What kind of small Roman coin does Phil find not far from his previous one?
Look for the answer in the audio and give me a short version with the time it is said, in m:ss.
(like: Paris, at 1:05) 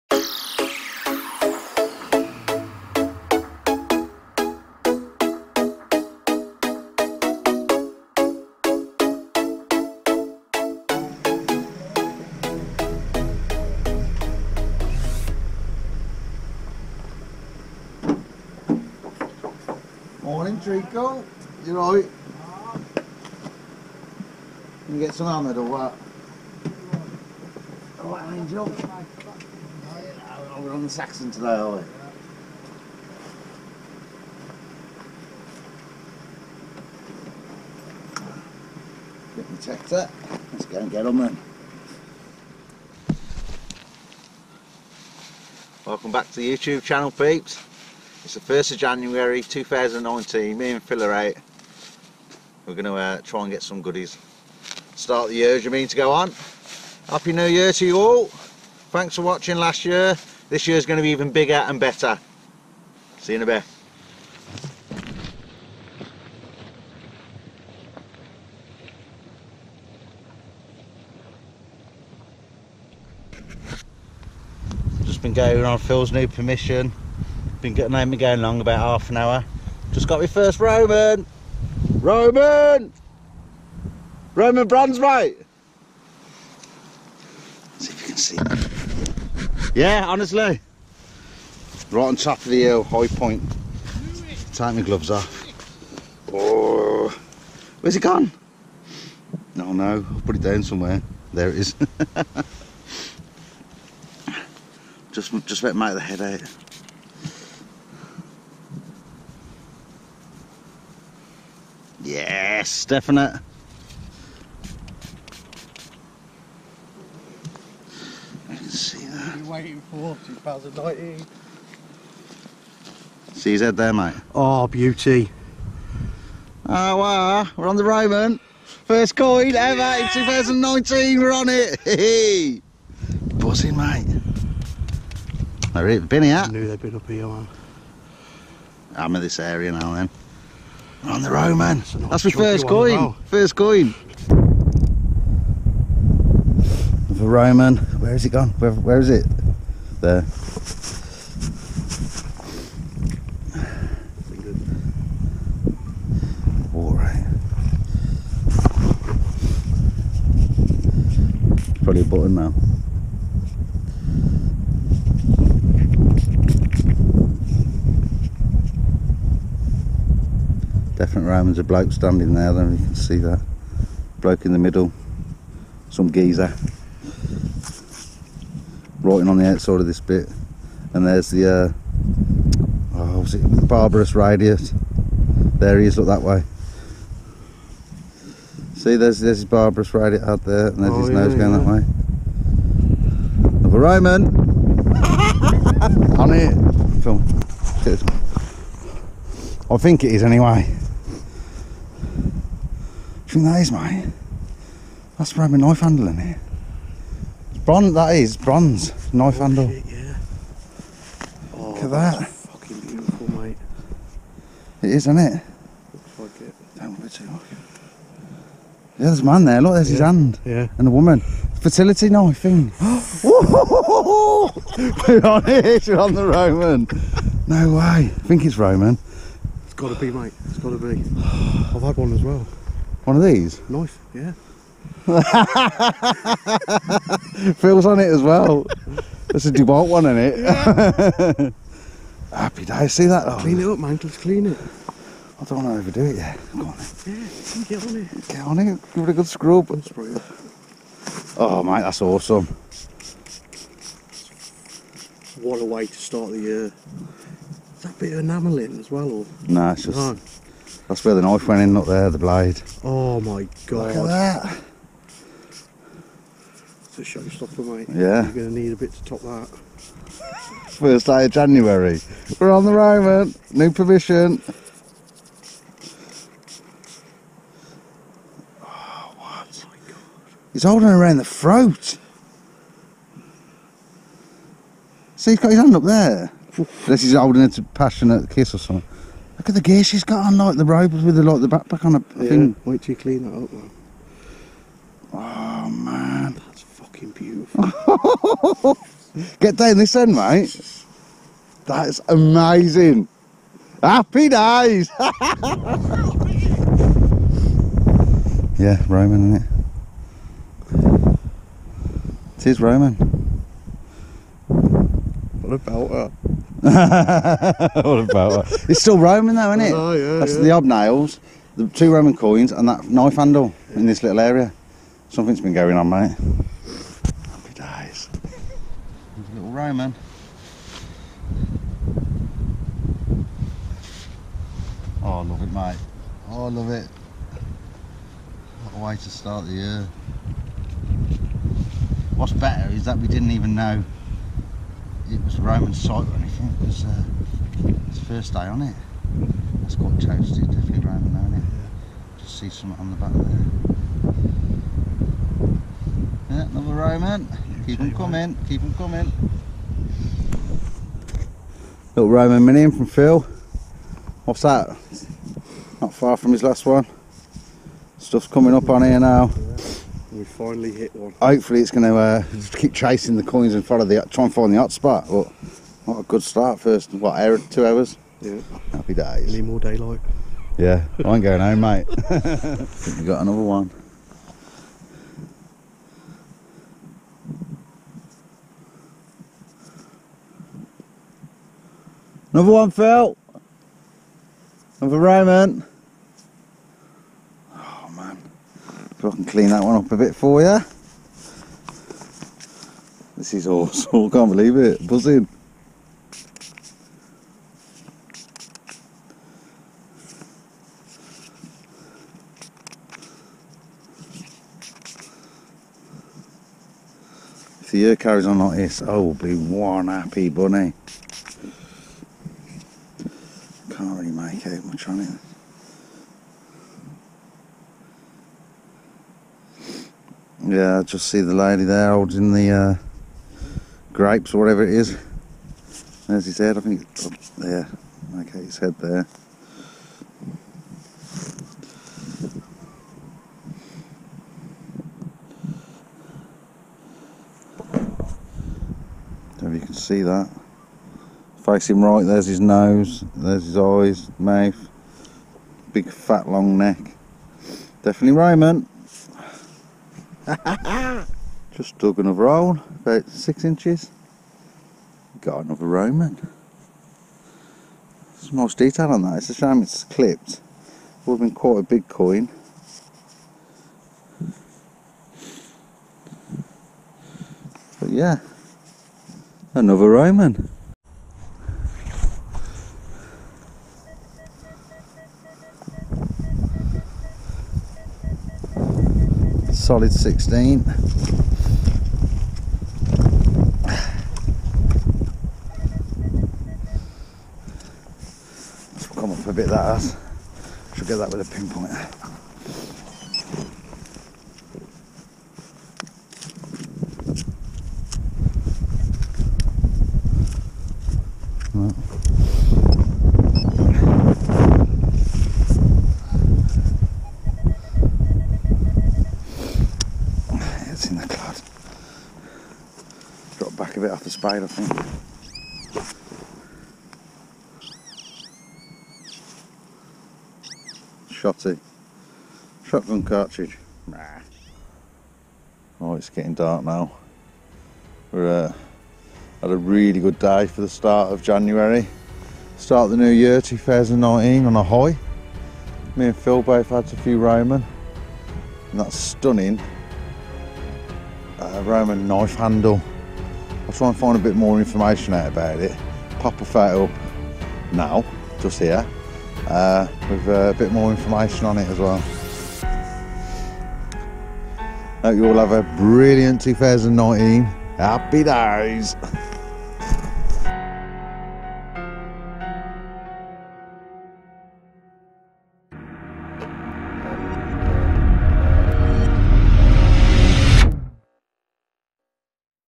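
Minim, at 6:02.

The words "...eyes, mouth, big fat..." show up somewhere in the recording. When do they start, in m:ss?
7:33.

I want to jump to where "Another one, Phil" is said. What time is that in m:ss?
6:32.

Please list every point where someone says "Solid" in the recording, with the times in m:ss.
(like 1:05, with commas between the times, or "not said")
8:09.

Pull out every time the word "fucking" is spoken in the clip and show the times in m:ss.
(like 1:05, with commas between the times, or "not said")
3:32, 4:56.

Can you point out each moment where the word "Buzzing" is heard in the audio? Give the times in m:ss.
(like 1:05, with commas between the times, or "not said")
2:13, 6:44.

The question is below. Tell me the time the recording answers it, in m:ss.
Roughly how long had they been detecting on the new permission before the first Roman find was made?
1:18.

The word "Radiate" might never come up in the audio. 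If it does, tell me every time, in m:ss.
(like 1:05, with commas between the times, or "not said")
3:04, 3:09.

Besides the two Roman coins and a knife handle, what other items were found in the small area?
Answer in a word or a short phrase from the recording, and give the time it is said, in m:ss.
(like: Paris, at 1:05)
Hobnails, at 5:20.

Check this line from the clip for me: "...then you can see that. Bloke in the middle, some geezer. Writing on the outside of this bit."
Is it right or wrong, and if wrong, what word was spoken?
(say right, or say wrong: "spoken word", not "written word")
right.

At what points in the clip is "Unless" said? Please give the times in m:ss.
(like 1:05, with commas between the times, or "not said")
4:46.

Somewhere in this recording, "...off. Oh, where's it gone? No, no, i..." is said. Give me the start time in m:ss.
1:35.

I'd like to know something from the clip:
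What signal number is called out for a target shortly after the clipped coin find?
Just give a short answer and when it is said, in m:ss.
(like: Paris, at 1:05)
16, at 8:09.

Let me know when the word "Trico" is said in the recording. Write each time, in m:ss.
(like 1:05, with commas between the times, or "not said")
0:20.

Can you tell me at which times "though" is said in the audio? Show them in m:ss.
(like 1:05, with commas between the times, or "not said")
4:03, 5:19.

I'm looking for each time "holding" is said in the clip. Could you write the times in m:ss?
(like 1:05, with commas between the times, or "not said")
4:40, 4:47, 7:11.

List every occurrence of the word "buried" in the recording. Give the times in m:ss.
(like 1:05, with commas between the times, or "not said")
not said.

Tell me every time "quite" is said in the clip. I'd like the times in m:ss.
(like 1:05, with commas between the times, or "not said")
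5:49, 7:51.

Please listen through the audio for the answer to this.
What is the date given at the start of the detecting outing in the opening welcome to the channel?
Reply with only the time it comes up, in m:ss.
0:48.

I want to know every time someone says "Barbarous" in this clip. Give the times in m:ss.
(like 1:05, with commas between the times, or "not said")
3:03, 3:09.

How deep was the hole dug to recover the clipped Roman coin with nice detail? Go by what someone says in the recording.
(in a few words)
About six inches.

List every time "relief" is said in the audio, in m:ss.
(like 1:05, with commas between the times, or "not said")
not said.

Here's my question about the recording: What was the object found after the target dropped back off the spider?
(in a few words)
Shotgun cartridge.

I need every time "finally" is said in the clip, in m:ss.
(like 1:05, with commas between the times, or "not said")
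6:10.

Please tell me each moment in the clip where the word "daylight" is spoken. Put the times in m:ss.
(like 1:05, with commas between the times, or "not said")
6:19.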